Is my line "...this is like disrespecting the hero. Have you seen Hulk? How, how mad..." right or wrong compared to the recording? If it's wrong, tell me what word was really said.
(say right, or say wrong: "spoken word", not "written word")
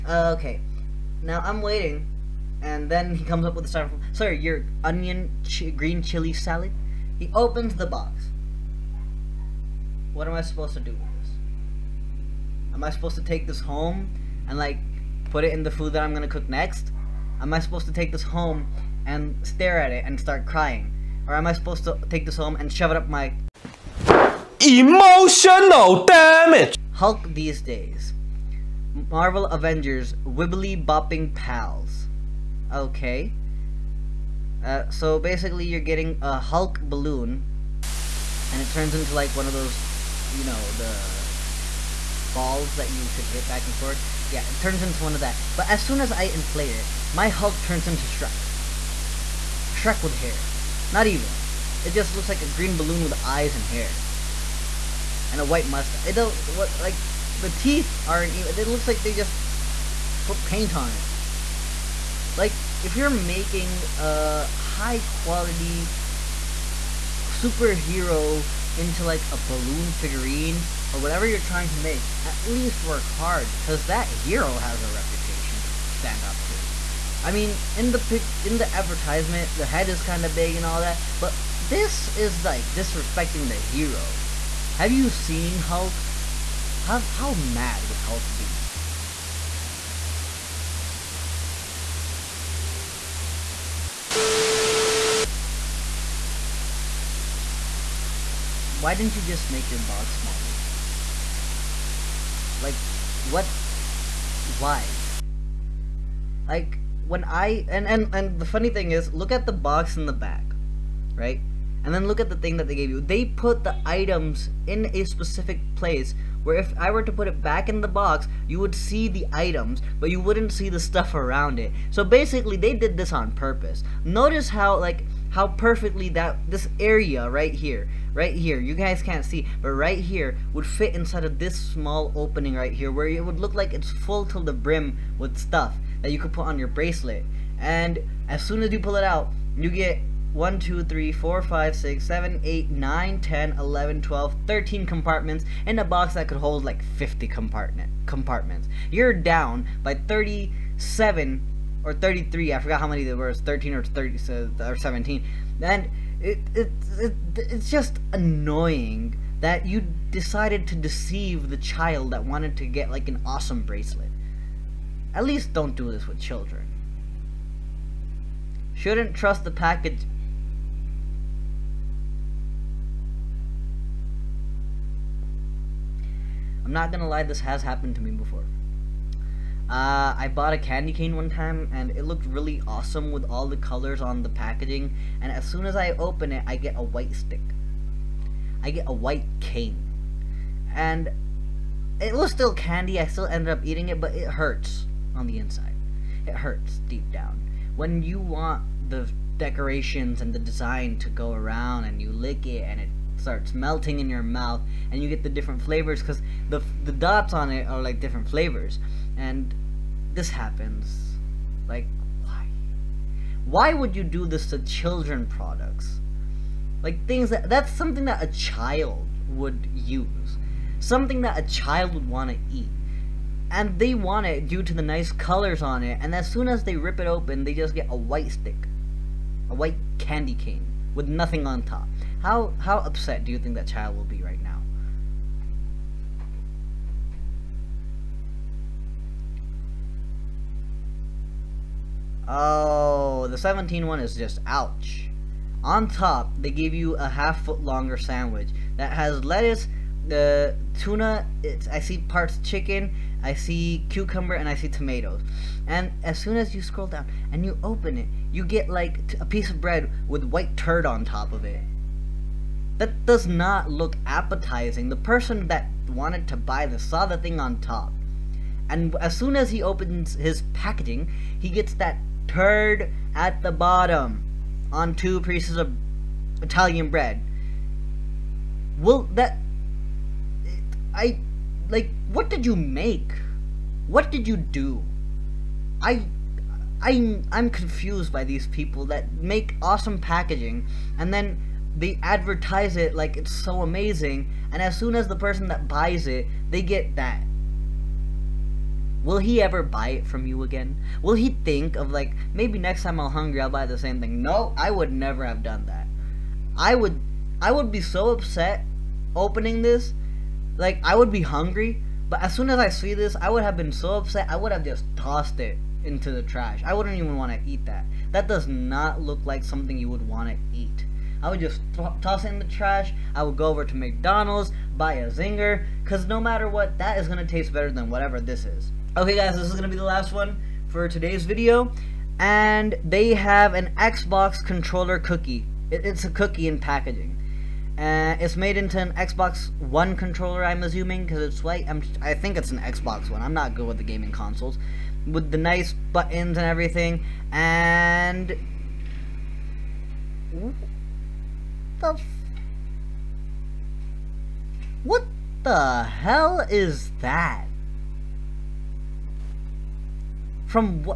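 right.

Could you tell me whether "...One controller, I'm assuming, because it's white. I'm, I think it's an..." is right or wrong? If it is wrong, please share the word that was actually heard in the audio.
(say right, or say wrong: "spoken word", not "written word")
right.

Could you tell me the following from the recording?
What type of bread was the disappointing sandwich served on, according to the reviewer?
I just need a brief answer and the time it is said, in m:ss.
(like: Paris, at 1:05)
Italian bread, at 4:36.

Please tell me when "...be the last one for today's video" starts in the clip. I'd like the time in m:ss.
5:29.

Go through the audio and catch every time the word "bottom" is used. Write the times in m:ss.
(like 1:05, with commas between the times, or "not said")
4:33.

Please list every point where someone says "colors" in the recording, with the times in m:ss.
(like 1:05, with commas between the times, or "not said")
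3:03, 3:45.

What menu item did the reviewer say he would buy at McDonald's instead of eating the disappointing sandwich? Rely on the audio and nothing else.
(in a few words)
Zinger.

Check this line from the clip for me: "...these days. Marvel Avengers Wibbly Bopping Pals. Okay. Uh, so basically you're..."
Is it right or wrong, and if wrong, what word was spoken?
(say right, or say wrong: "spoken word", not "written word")
right.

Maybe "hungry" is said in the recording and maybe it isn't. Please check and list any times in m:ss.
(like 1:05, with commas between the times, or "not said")
5:03, 5:11.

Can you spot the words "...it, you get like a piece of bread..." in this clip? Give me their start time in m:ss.
4:17.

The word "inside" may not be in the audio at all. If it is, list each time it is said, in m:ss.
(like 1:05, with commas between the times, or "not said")
2:10, 3:15.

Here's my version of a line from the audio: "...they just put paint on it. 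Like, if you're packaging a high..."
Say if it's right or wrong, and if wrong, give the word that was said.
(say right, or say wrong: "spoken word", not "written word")
wrong: "making", not "packaging".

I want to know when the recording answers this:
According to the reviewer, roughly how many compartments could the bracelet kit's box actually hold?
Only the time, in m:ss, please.
2:26.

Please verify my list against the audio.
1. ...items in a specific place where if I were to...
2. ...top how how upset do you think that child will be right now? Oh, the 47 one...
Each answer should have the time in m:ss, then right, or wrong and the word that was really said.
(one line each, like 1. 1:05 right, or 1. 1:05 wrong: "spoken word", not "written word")
1. 1:53 right
2. 3:51 wrong: "17", not "47".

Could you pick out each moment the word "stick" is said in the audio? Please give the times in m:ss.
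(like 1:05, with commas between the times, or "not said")
3:07, 3:48.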